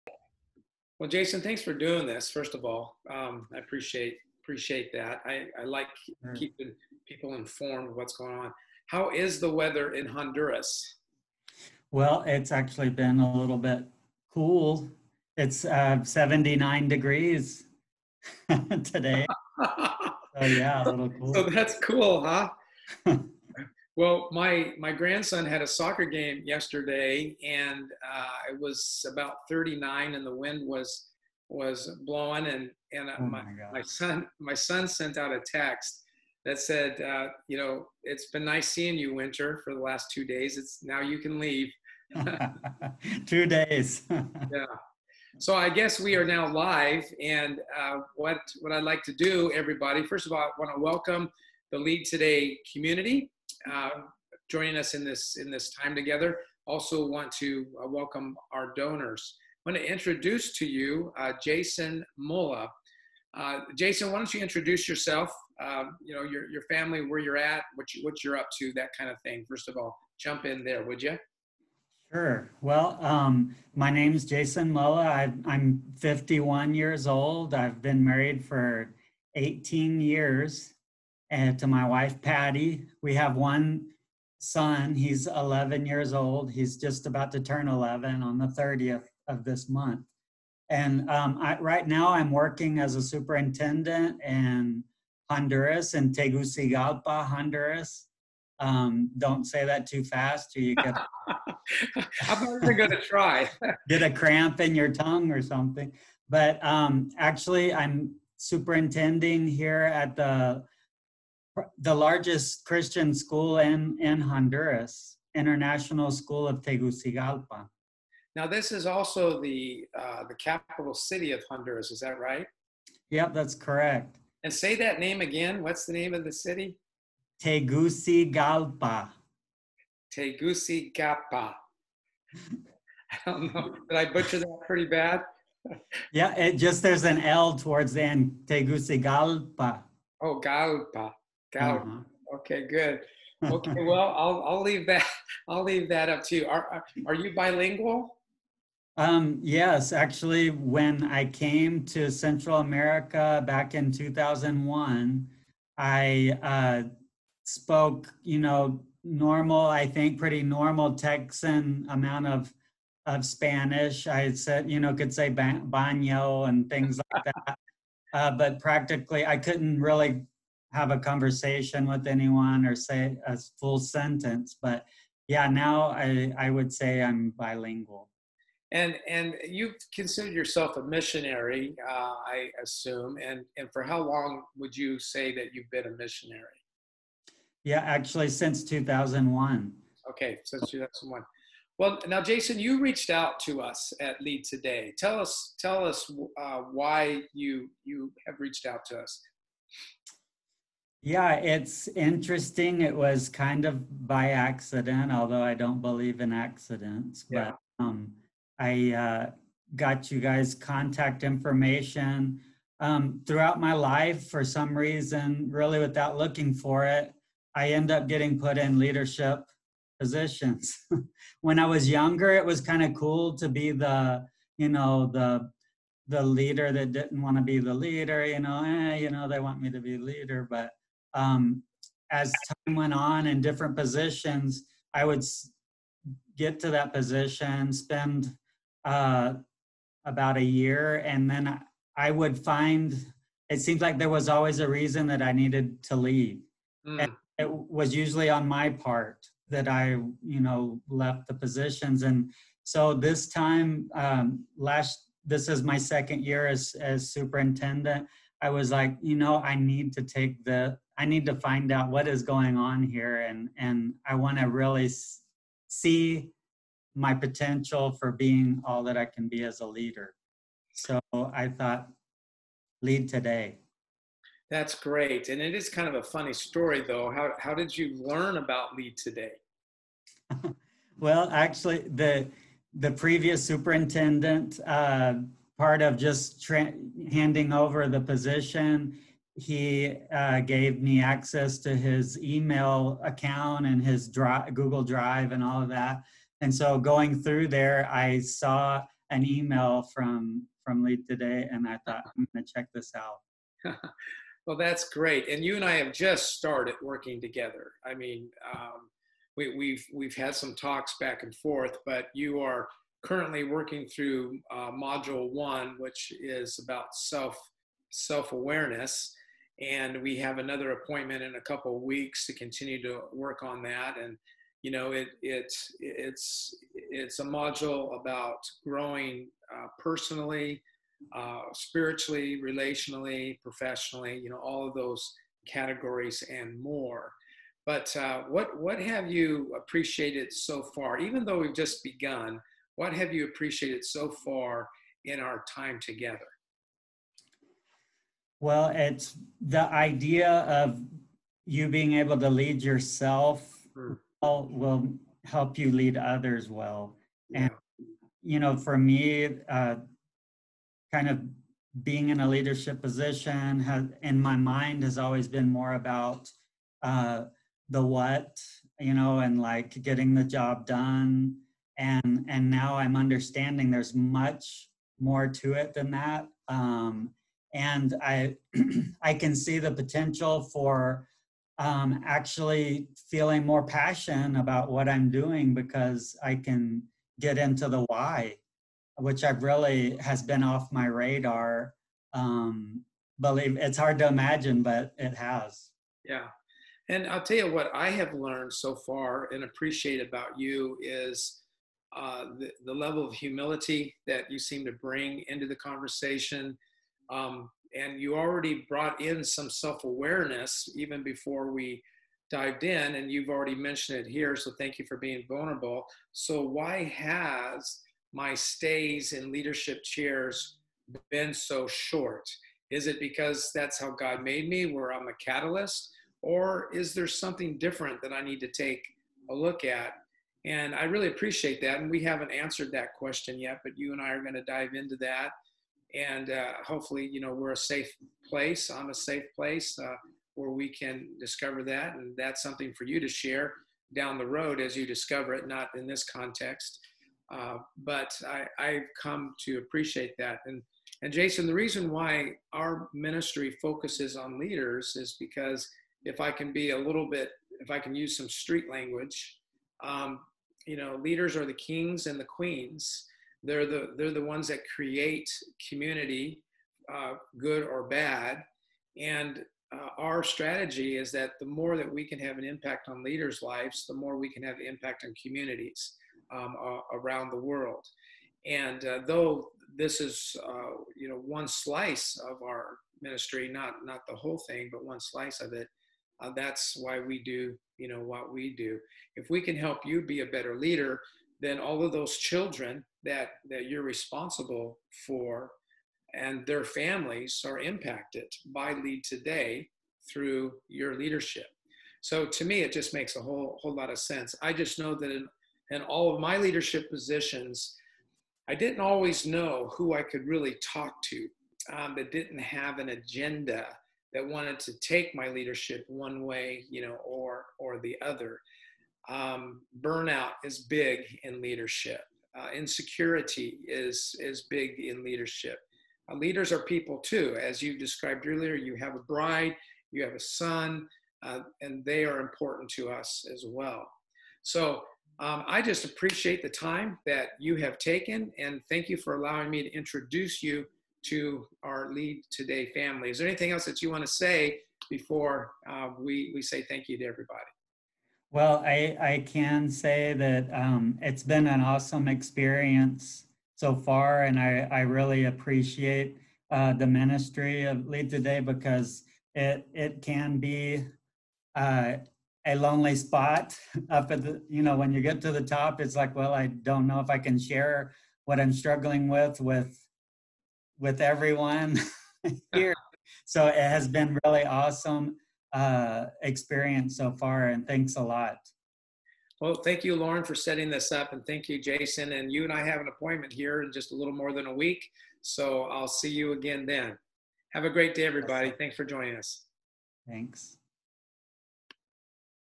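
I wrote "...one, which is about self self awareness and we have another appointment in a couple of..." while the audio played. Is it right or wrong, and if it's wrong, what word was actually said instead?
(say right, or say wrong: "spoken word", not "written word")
right.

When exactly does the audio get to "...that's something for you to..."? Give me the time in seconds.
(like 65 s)
442 s.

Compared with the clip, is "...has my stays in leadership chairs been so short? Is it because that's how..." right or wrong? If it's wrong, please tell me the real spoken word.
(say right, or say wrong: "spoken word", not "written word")
right.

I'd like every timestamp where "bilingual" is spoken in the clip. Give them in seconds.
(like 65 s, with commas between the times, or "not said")
147 s, 177 s.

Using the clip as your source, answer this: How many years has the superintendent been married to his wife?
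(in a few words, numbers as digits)
18 years.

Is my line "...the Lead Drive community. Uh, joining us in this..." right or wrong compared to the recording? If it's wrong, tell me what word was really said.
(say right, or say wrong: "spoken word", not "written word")
wrong: "Today", not "Drive".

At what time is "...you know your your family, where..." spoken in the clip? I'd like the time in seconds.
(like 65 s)
66 s.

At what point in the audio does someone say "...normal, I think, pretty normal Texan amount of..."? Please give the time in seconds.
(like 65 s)
159 s.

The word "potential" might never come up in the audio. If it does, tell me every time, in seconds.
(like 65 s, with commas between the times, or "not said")
267 s, 379 s.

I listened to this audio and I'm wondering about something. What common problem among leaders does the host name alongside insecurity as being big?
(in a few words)
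Burnout.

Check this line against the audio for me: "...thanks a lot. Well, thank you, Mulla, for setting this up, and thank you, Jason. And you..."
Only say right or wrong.
wrong.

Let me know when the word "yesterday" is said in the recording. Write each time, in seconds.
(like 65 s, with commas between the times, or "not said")
26 s.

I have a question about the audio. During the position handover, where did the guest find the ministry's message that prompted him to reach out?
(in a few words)
Email account.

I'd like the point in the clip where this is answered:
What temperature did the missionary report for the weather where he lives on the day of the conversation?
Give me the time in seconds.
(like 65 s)
16 s.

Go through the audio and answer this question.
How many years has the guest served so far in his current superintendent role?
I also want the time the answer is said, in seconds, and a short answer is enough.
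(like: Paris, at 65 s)
second year, at 255 s.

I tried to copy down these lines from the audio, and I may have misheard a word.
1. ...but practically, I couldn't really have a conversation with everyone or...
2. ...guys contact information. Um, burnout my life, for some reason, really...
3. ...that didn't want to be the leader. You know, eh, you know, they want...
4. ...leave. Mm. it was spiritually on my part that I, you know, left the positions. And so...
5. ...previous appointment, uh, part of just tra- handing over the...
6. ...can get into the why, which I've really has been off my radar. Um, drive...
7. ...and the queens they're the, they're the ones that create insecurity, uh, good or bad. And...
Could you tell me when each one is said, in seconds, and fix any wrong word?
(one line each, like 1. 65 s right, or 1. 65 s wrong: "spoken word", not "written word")
1. 168 s wrong: "anyone", not "everyone"
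2. 210 s wrong: "throughout", not "burnout"
3. 226 s right
4. 245 s wrong: "usually", not "spiritually"
5. 282 s wrong: "superintendent", not "appointment"
6. 386 s wrong: "believe", not "drive"
7. 462 s wrong: "community", not "insecurity".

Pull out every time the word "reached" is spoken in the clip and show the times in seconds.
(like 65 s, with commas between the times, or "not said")
192 s, 198 s.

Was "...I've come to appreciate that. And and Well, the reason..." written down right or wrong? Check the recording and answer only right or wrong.
wrong.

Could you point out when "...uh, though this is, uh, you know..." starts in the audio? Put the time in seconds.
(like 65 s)
478 s.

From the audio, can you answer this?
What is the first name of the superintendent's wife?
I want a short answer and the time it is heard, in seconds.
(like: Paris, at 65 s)
Patty, at 82 s.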